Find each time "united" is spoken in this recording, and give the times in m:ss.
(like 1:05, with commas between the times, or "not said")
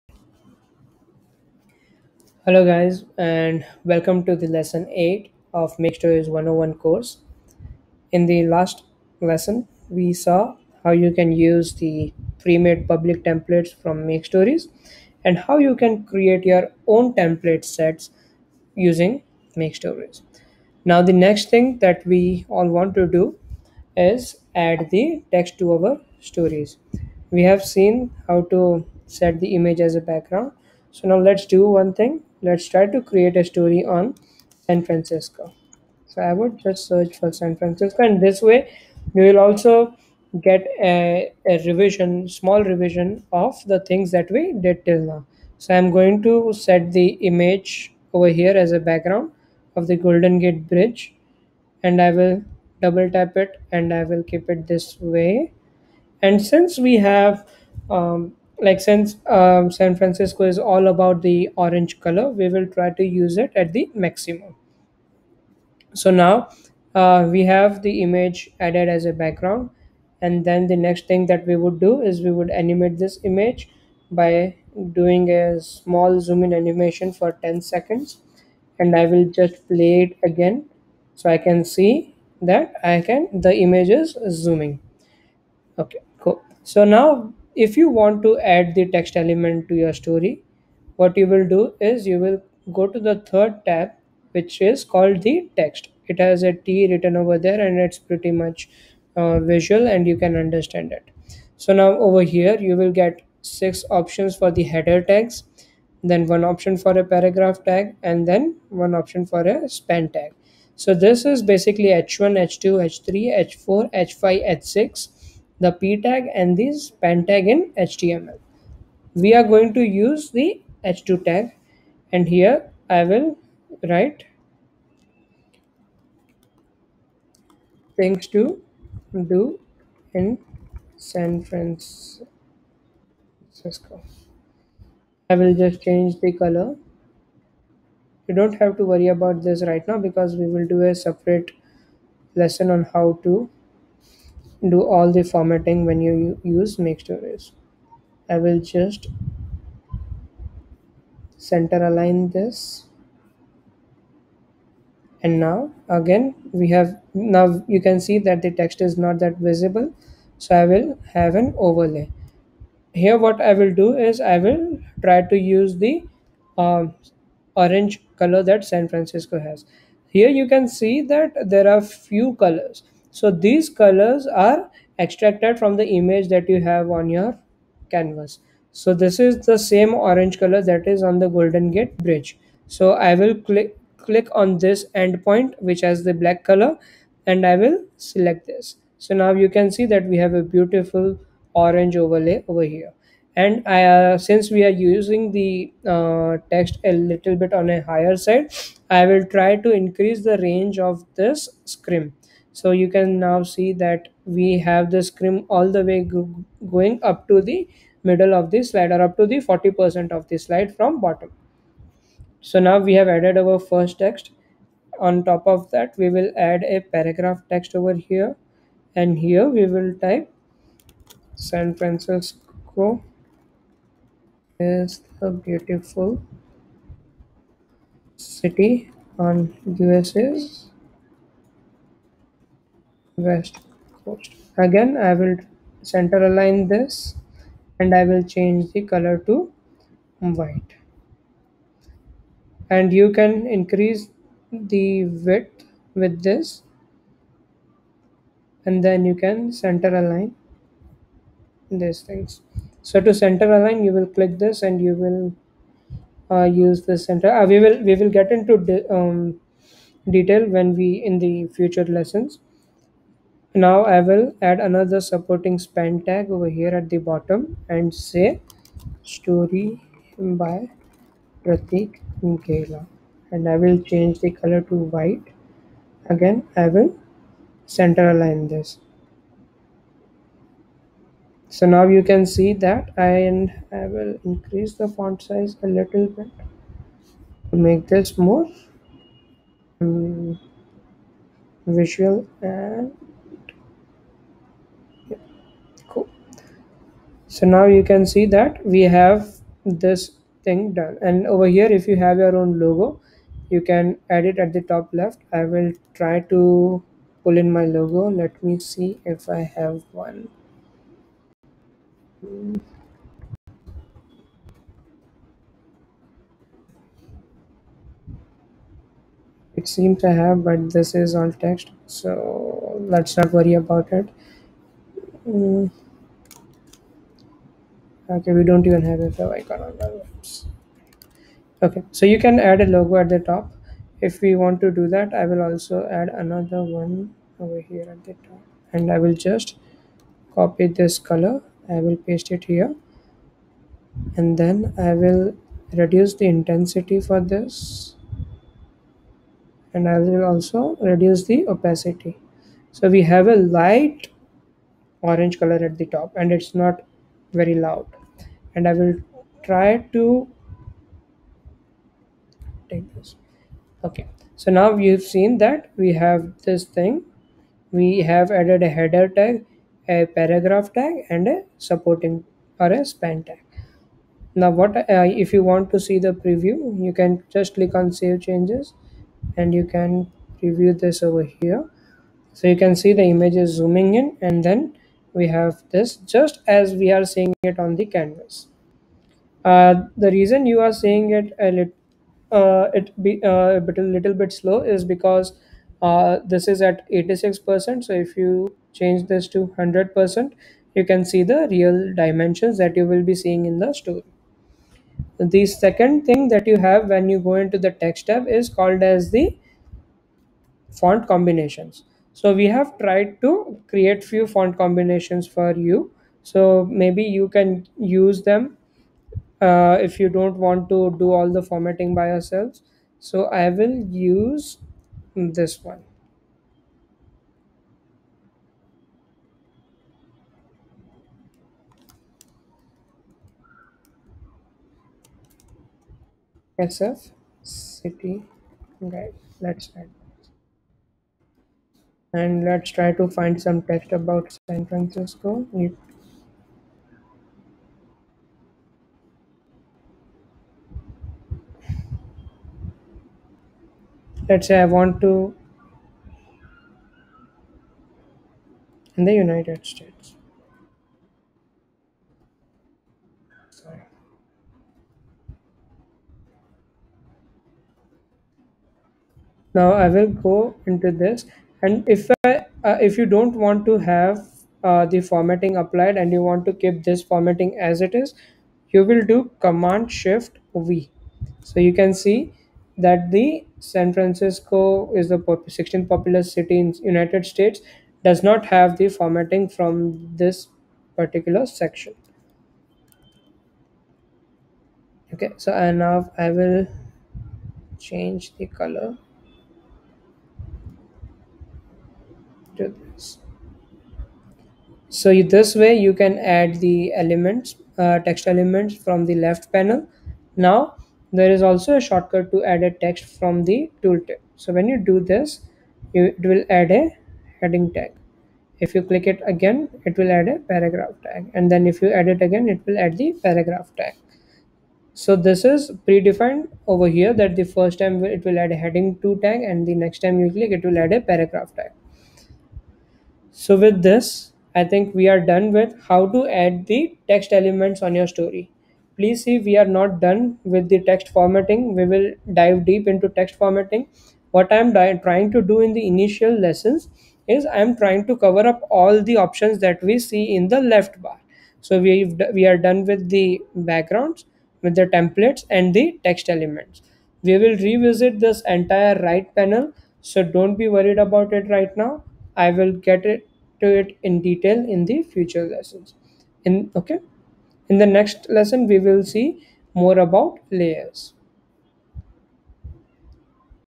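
7:39, 8:06.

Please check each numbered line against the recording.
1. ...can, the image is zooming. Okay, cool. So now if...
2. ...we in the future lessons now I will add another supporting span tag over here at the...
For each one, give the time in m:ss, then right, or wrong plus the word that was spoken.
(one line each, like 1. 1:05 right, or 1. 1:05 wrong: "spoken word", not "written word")
1. 1:23 right
2. 4:20 right.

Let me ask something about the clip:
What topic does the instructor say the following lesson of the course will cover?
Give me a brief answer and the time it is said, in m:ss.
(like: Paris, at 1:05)
Layers, at 9:30.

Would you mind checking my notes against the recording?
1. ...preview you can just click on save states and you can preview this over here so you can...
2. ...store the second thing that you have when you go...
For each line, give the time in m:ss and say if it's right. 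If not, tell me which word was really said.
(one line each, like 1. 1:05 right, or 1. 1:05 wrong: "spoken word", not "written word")
1. 6:16 wrong: "changes", not "states"
2. 6:43 right.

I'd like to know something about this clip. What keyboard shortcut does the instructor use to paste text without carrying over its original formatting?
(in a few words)
Command Shift V.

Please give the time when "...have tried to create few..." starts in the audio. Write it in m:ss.
6:52.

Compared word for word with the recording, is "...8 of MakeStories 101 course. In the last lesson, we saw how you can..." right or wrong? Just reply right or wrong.
right.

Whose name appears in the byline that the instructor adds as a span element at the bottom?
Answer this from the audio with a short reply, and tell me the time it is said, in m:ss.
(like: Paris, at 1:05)
Pratik Gela, at 4:31.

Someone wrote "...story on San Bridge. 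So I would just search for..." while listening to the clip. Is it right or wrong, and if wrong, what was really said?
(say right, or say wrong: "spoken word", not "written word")
wrong: "Francisco", not "Bridge".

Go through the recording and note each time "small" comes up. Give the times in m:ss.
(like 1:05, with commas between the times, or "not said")
0:42, 1:15.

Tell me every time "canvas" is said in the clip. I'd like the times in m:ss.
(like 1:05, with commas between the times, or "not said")
2:57, 6:27.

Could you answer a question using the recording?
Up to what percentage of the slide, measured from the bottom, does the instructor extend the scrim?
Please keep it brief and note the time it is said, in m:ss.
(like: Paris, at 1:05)
40%, at 3:29.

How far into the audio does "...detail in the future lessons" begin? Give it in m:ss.
9:24.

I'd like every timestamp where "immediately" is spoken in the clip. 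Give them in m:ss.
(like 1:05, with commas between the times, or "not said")
not said.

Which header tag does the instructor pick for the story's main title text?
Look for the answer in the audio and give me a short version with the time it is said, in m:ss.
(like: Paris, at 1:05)
h2, at 2:00.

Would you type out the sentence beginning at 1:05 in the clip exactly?
So now uh, we have the image added as a background.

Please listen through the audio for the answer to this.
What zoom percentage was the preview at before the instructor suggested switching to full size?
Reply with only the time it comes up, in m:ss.
6:36.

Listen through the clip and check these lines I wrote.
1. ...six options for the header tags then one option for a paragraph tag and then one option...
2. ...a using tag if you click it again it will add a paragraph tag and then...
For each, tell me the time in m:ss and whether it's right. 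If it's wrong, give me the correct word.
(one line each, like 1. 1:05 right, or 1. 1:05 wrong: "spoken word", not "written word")
1. 1:43 right
2. 8:36 wrong: "heading", not "using".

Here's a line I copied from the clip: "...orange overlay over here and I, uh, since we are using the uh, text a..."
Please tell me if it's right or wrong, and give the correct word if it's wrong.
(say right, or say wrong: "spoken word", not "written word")
right.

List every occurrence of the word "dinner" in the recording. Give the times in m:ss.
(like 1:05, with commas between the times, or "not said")
not said.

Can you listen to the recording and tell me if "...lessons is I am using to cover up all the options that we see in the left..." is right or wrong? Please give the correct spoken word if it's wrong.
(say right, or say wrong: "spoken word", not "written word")
wrong: "trying", not "using".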